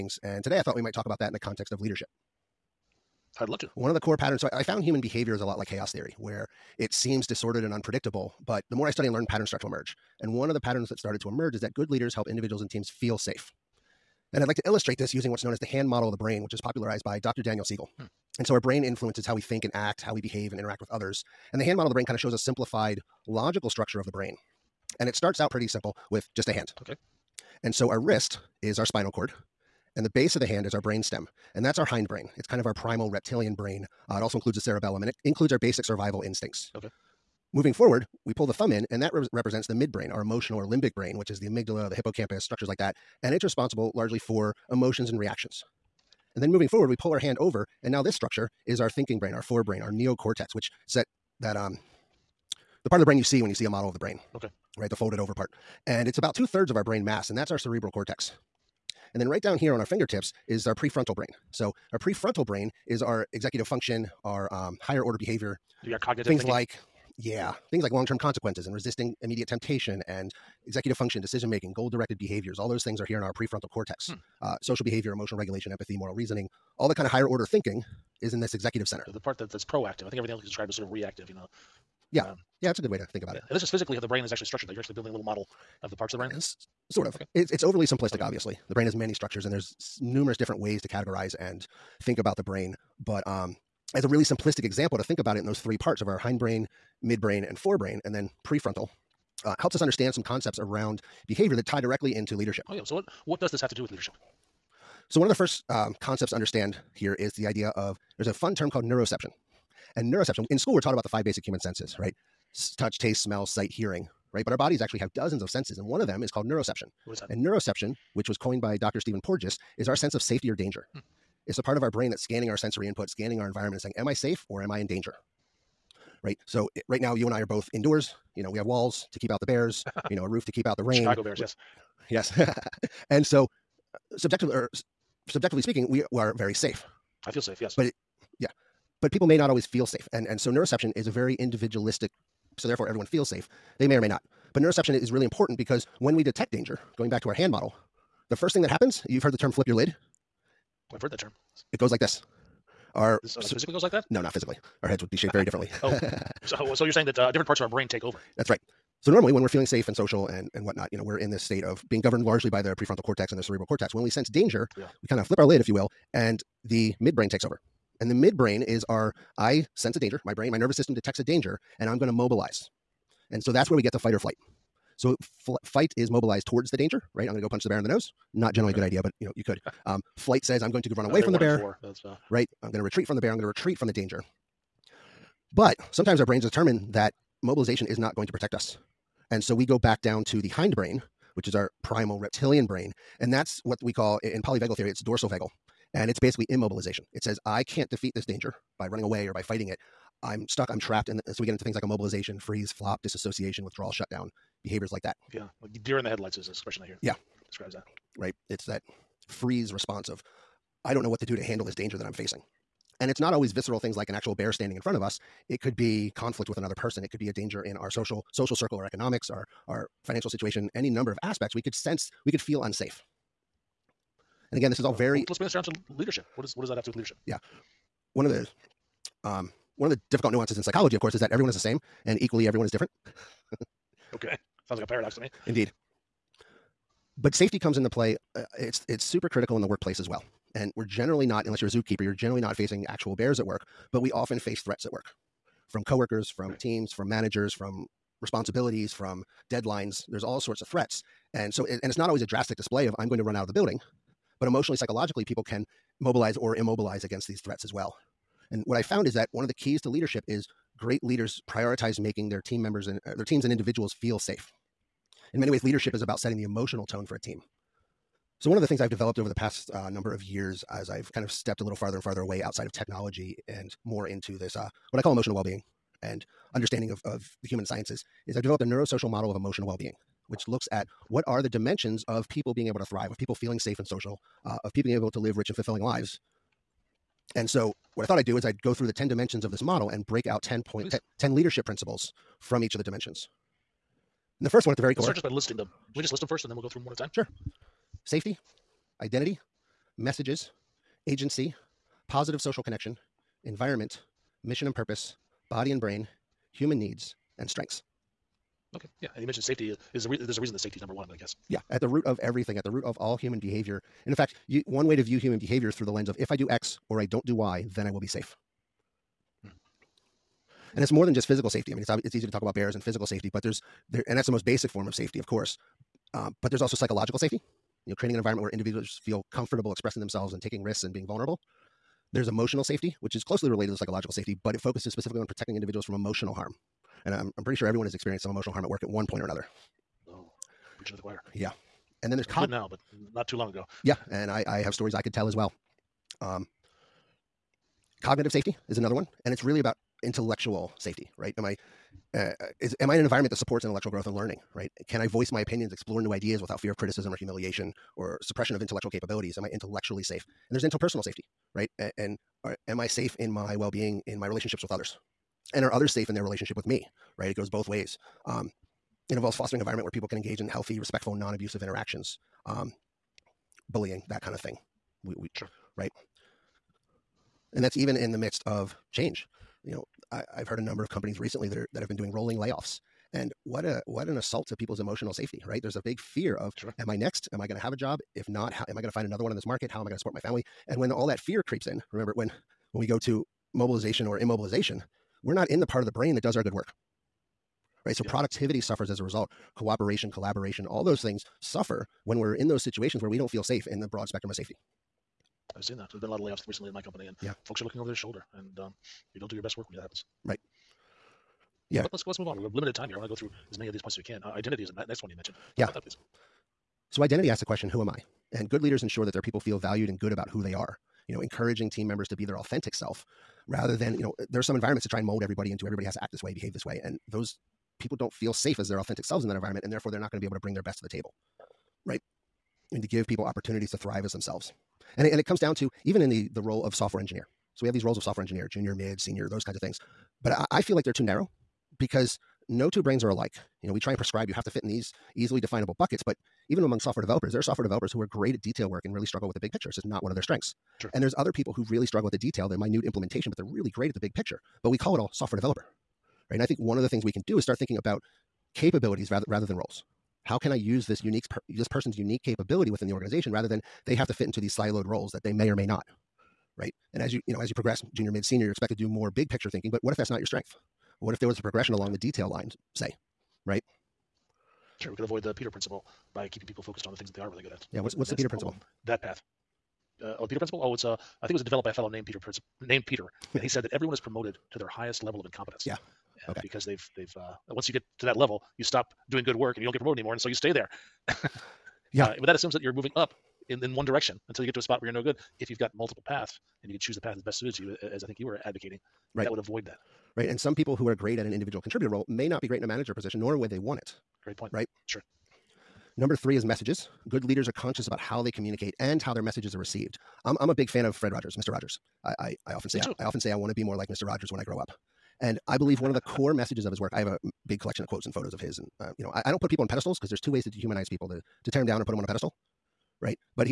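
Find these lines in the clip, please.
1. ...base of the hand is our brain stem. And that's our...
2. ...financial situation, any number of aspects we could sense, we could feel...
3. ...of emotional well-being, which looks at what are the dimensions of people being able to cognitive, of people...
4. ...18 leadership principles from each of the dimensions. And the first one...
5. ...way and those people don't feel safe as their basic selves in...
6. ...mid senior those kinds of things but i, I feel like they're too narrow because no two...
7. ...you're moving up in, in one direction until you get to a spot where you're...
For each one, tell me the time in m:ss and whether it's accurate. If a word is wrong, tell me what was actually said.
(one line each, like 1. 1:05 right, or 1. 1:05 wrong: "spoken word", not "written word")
1. 0:30 right
2. 3:40 right
3. 4:39 wrong: "thrive", not "cognitive"
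4. 4:51 wrong: "10", not "18"
5. 7:06 wrong: "authentic", not "basic"
6. 7:18 right
7. 8:12 right.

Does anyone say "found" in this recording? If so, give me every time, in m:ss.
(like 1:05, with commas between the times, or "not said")
0:04, 4:18.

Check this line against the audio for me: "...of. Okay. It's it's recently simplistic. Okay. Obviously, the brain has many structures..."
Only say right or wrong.
wrong.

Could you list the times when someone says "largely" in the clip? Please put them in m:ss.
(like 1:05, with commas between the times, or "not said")
0:43, 2:42.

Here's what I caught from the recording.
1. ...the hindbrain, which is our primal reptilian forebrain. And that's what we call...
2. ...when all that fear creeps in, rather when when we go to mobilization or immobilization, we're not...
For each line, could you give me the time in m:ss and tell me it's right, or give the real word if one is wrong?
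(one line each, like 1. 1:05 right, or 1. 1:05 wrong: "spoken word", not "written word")
1. 3:10 wrong: "brain", not "forebrain"
2. 6:30 wrong: "remember", not "rather".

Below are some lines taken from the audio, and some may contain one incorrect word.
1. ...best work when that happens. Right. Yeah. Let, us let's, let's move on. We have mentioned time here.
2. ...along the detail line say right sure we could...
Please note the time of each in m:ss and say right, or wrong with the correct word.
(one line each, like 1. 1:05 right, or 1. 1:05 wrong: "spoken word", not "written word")
1. 6:49 wrong: "limited", not "mentioned"
2. 7:51 right.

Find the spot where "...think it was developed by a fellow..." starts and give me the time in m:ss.
8:01.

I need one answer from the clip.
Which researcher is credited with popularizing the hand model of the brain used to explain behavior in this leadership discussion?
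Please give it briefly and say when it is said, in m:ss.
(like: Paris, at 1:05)
Dr. Daniel Siegel, at 0:17.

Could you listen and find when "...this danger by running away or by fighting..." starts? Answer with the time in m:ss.
3:18.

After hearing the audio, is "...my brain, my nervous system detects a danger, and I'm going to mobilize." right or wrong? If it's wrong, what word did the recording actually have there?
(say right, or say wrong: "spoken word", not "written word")
right.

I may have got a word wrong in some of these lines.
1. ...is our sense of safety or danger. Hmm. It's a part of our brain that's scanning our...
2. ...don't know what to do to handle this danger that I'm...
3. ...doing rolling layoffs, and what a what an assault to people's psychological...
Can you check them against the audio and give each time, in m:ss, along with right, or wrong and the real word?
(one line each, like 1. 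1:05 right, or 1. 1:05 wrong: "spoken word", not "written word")
1. 1:59 right
2. 3:30 right
3. 6:21 wrong: "emotional", not "psychological".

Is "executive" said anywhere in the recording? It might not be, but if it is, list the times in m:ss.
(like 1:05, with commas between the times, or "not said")
1:03, 1:10, 1:18.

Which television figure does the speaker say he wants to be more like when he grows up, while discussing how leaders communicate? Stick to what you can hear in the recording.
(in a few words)
Fred Rogers.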